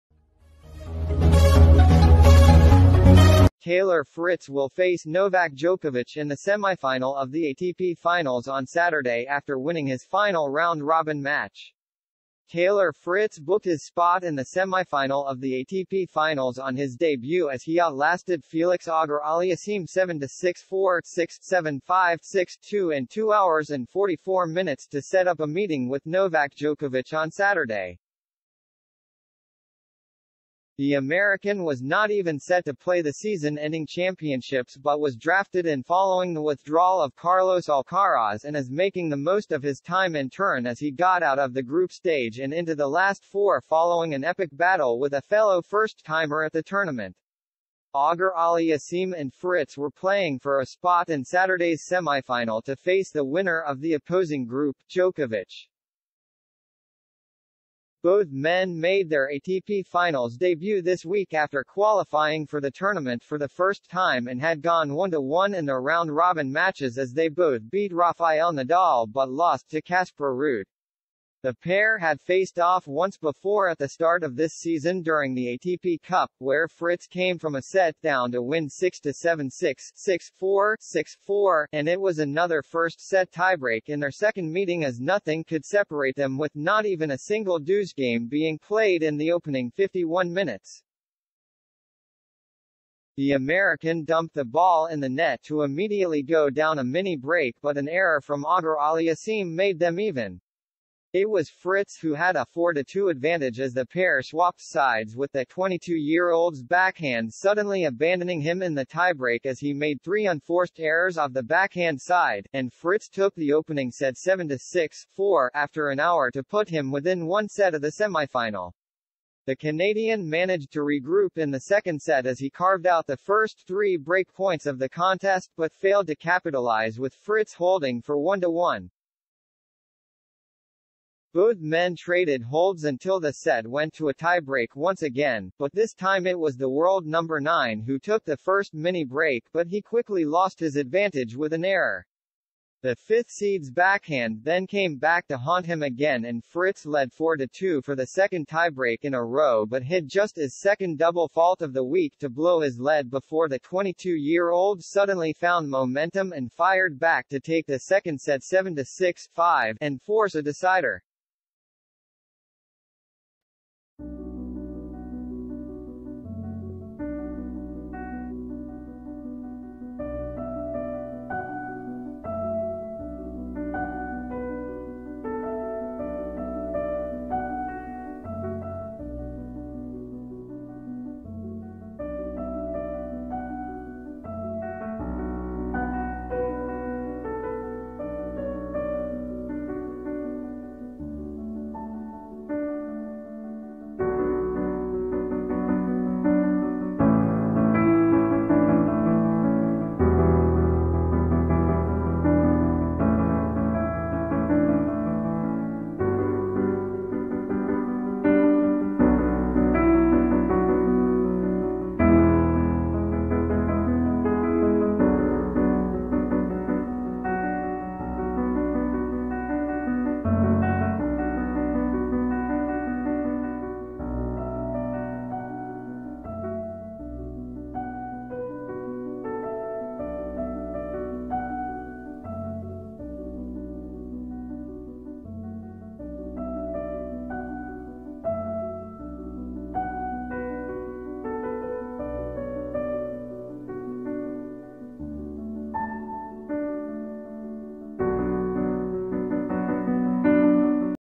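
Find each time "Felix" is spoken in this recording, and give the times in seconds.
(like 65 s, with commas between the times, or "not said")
18 s.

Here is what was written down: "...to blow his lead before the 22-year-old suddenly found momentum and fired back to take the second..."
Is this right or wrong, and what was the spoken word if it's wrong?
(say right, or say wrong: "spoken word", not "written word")
right.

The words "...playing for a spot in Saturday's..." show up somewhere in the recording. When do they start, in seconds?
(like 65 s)
49 s.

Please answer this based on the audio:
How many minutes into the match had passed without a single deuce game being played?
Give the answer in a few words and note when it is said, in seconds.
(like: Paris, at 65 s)
51, at 89 s.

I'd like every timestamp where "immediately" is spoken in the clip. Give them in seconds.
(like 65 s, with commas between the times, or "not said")
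95 s.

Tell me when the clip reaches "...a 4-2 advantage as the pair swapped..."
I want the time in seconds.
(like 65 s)
102 s.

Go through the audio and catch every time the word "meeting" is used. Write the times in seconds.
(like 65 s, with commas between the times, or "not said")
25 s, 84 s.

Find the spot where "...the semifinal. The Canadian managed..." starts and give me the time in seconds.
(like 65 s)
117 s.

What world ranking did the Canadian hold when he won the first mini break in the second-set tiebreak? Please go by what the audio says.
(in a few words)
9.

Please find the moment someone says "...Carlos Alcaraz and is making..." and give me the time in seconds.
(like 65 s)
37 s.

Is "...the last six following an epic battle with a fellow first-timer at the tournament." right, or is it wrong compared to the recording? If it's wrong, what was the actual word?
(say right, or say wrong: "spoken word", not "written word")
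wrong: "four", not "six".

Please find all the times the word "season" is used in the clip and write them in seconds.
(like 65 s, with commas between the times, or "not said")
33 s, 74 s.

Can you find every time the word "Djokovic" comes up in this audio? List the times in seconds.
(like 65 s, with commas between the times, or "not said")
5 s, 26 s, 54 s.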